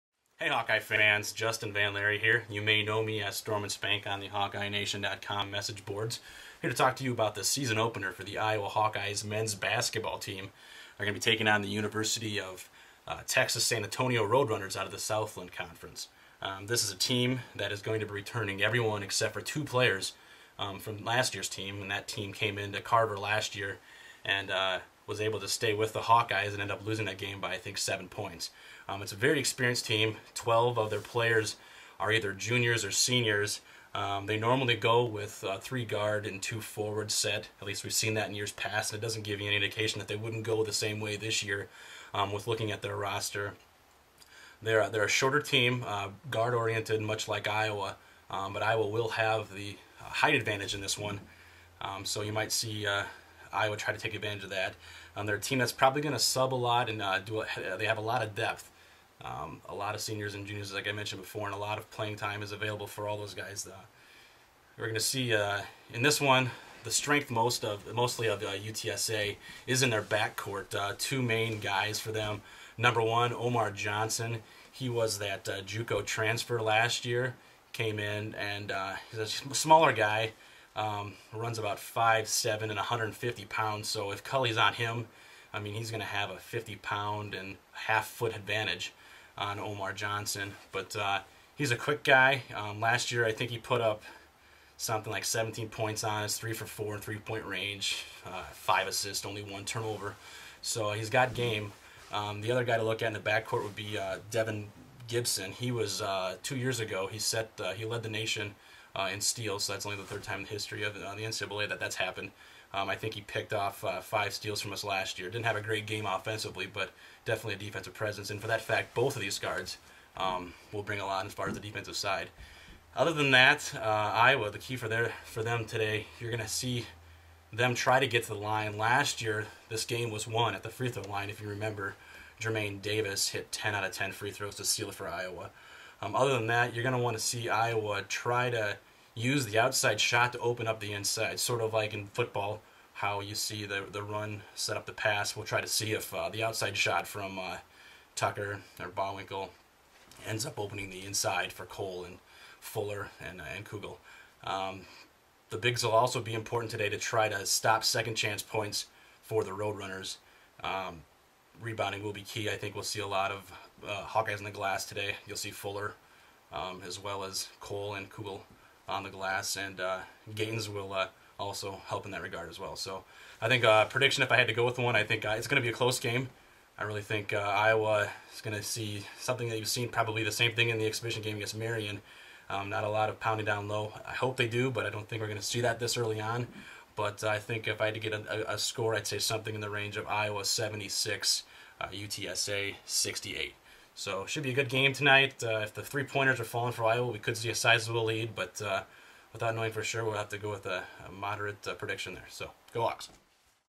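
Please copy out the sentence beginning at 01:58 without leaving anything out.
And for that fact, both of these guards um, will bring a lot as far as the defensive side.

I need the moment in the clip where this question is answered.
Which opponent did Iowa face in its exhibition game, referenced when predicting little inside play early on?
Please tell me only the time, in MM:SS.
03:01.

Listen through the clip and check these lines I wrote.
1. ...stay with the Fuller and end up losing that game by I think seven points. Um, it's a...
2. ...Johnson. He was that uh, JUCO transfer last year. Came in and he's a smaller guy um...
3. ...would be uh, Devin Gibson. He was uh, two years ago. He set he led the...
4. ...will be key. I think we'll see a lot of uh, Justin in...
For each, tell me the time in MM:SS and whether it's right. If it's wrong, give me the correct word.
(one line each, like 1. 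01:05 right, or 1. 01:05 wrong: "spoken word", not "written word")
1. 00:25 wrong: "Hawkeyes", not "Fuller"
2. 01:13 right
3. 01:43 right
4. 02:42 wrong: "Hawkeyes", not "Justin".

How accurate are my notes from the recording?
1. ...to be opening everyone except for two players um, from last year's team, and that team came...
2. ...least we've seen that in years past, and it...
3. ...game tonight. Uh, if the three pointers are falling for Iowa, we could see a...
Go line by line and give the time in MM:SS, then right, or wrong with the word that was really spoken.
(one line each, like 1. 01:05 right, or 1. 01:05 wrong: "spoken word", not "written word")
1. 00:17 wrong: "returning", not "opening"
2. 00:37 right
3. 03:14 right.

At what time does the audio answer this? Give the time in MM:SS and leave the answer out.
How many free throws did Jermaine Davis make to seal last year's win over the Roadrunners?
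02:13.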